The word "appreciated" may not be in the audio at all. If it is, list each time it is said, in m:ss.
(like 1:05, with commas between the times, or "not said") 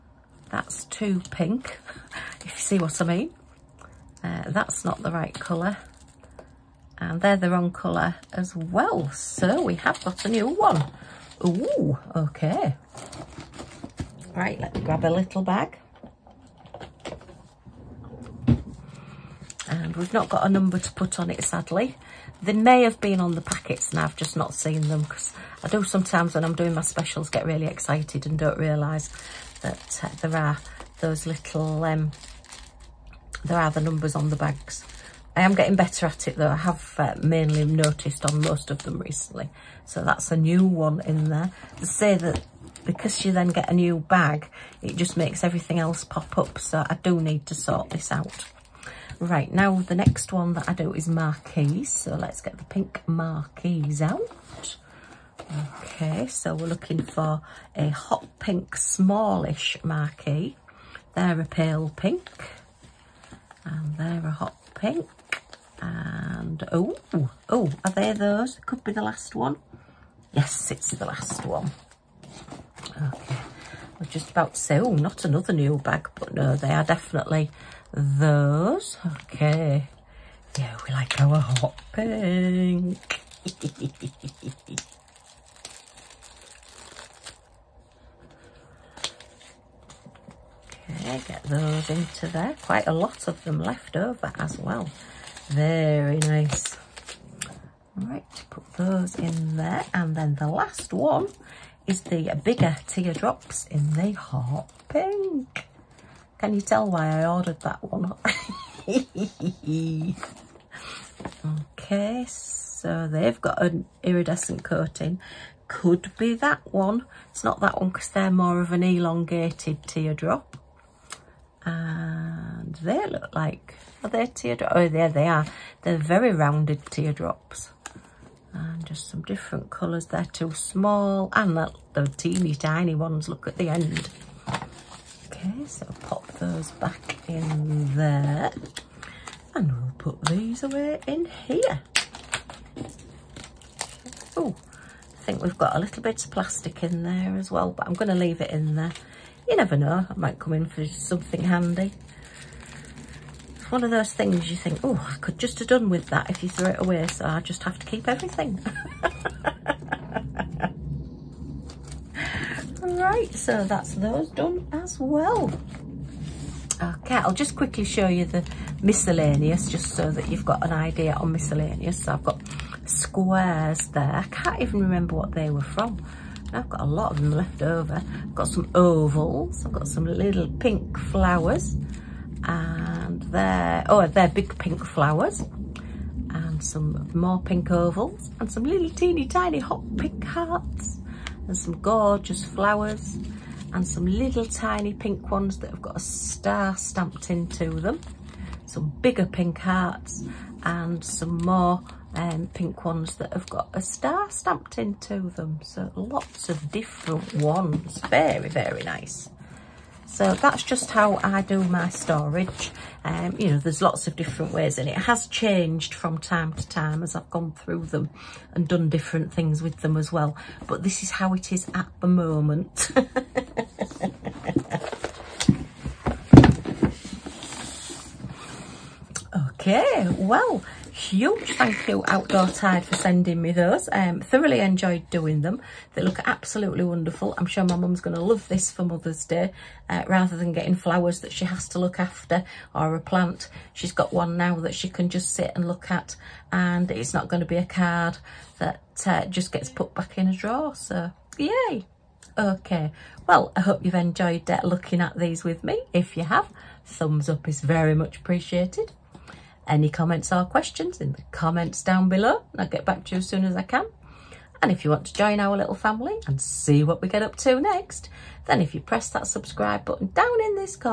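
4:18.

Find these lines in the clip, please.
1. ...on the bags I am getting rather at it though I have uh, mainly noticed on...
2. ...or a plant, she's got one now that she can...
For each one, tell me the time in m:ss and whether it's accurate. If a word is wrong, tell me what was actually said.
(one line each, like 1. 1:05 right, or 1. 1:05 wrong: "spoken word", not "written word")
1. 0:34 wrong: "better", not "rather"
2. 4:02 right.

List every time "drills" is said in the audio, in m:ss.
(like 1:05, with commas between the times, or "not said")
not said.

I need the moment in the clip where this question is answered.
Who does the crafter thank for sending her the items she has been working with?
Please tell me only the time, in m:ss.
3:52.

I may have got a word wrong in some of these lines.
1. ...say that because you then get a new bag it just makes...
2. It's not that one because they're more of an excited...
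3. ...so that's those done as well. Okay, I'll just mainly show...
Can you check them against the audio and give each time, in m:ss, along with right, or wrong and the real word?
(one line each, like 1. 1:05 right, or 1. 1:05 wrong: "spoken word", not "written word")
1. 0:41 right
2. 1:57 wrong: "elongated", not "excited"
3. 2:43 wrong: "quickly", not "mainly".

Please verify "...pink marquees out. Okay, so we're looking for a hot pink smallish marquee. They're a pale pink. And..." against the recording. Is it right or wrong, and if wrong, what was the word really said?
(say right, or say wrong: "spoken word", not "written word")
right.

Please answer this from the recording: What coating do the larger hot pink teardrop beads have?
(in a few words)
Iridescent.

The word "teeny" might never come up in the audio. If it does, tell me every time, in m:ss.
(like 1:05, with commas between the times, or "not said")
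2:12, 3:08.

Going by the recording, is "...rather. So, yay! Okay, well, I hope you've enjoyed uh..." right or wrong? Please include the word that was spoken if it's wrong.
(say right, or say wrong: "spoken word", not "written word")
wrong: "drawer", not "rather".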